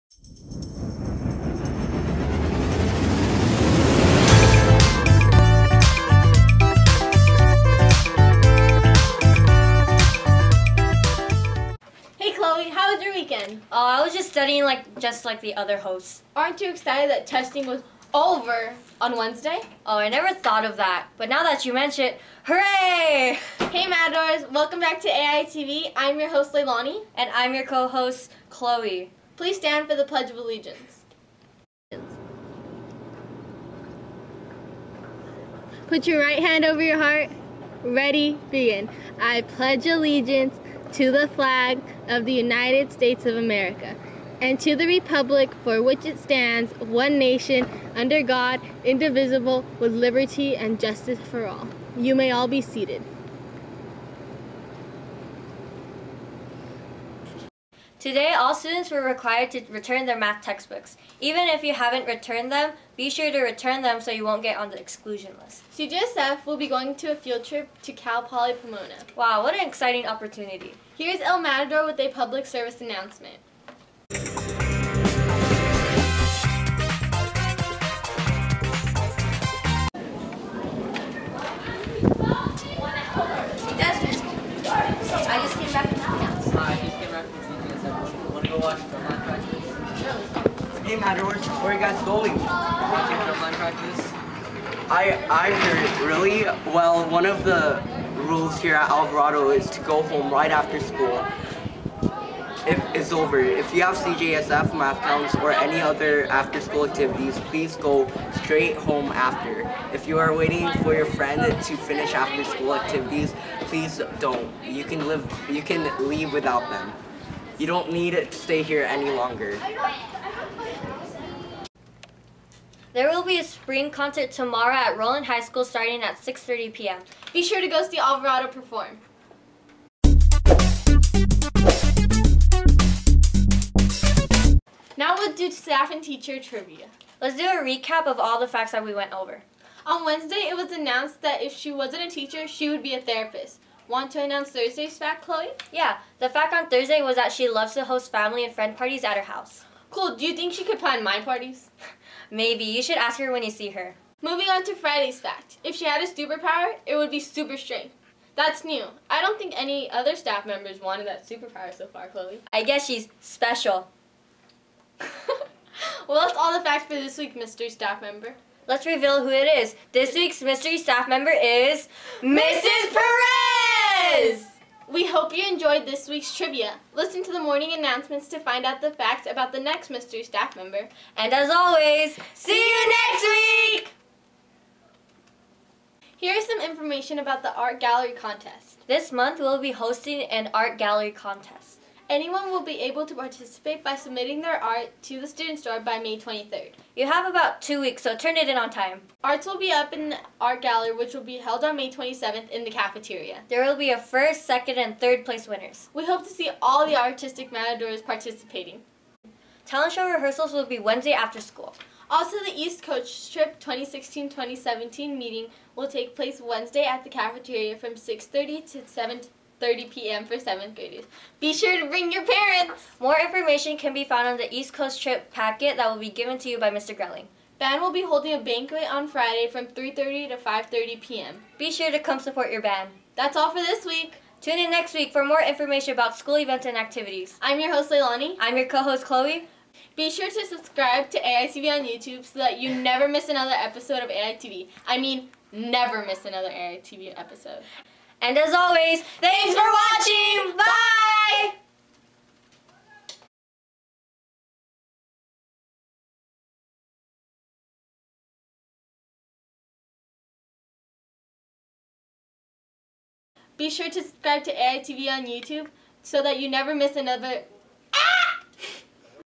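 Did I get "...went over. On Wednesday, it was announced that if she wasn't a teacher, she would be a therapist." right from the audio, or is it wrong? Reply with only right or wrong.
right.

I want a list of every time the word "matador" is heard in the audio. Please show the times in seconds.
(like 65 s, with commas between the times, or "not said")
71 s, 207 s.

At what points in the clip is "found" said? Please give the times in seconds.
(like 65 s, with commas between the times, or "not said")
224 s.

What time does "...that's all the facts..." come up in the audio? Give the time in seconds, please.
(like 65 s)
166 s.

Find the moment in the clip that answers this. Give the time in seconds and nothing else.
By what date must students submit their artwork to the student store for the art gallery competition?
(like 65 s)
195 s.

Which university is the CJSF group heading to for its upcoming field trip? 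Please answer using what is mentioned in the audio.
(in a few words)
Cal Poly Pomona.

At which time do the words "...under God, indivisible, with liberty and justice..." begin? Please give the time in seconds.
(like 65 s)
47 s.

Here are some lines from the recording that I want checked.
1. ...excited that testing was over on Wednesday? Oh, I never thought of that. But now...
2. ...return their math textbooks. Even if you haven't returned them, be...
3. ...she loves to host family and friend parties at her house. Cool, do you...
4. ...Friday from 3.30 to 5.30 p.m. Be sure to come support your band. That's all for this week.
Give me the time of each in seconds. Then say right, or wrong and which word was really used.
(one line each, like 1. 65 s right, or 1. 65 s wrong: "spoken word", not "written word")
1. 16 s right
2. 59 s right
3. 147 s right
4. 229 s right.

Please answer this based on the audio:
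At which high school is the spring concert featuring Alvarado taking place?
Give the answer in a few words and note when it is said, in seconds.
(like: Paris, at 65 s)
Rowland High School, at 124 s.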